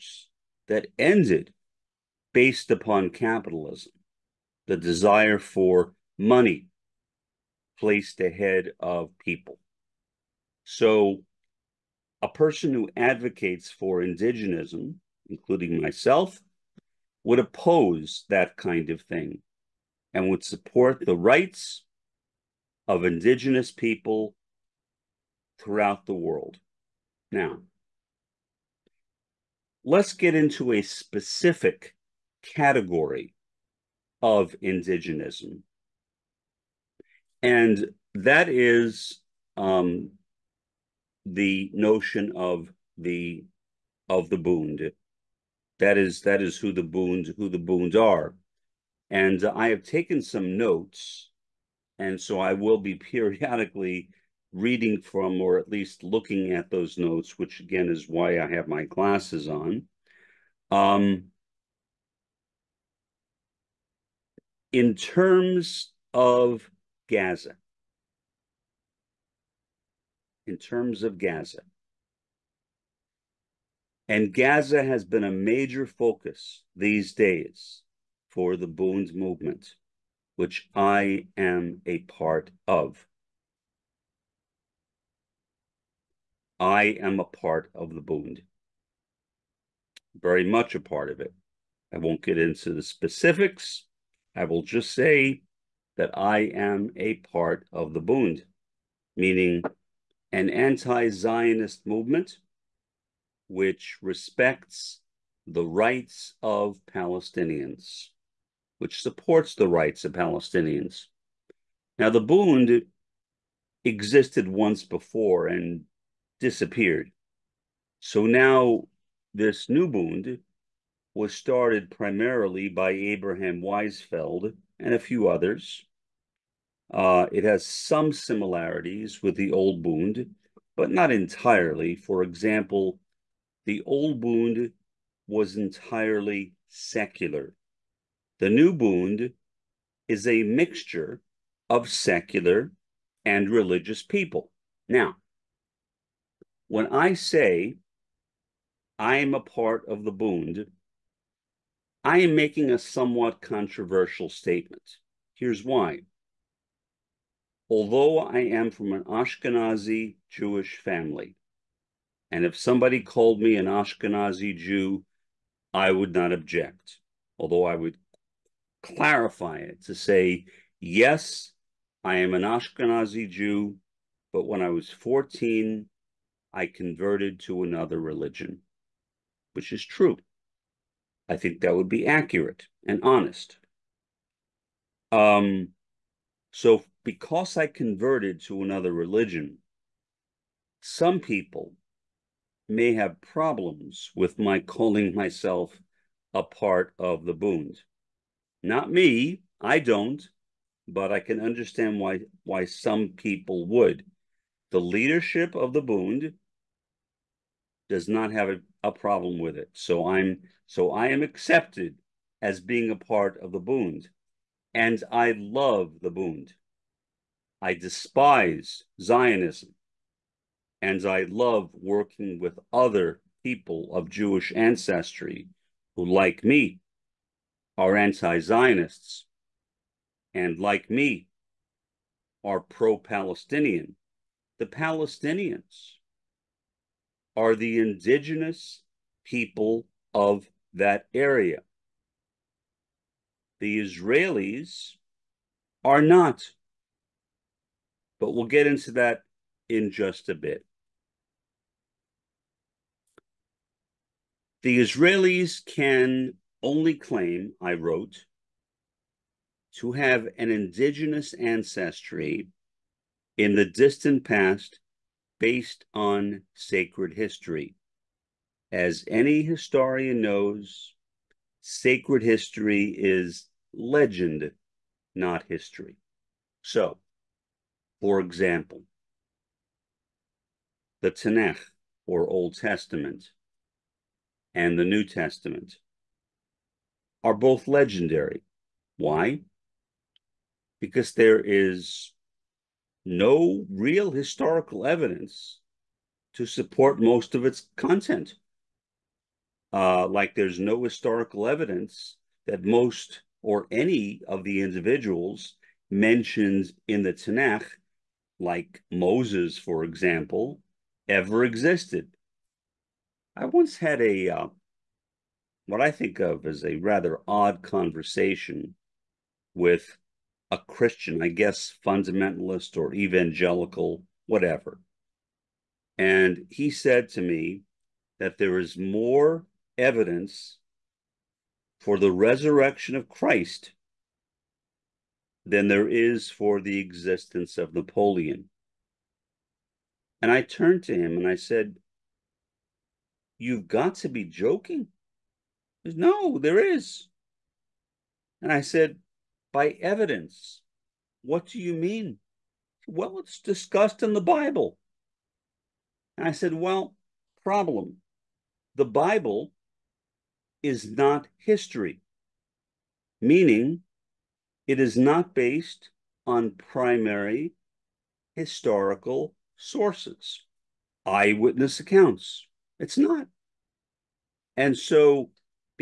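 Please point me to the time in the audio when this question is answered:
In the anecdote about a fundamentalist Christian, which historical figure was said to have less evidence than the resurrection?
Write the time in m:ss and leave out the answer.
5:37.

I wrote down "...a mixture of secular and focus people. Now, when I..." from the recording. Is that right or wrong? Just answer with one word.
wrong.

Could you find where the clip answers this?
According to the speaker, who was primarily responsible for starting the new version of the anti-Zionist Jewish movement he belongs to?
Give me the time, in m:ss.
2:02.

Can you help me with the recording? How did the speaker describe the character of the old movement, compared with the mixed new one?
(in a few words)
entirely secular.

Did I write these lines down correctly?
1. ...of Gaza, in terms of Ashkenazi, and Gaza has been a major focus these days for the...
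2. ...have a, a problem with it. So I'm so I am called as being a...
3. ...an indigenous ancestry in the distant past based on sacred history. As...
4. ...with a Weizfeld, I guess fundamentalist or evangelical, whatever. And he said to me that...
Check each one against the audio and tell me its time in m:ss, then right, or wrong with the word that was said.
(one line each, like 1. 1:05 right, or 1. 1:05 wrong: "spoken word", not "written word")
1. 1:06 wrong: "Gaza", not "Ashkenazi"
2. 3:28 wrong: "accepted", not "called"
3. 4:20 right
4. 5:19 wrong: "Christian", not "Weizfeld".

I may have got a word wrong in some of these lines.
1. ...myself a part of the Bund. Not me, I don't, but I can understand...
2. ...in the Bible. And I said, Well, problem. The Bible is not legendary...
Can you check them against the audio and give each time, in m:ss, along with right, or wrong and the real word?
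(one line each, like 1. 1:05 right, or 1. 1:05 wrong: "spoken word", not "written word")
1. 3:15 right
2. 5:54 wrong: "history", not "legendary".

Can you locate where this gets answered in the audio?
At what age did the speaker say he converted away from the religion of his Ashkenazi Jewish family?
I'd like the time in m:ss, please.
2:54.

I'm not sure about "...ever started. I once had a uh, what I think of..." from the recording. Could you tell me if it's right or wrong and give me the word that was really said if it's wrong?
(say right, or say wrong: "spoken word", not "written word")
wrong: "existed", not "started".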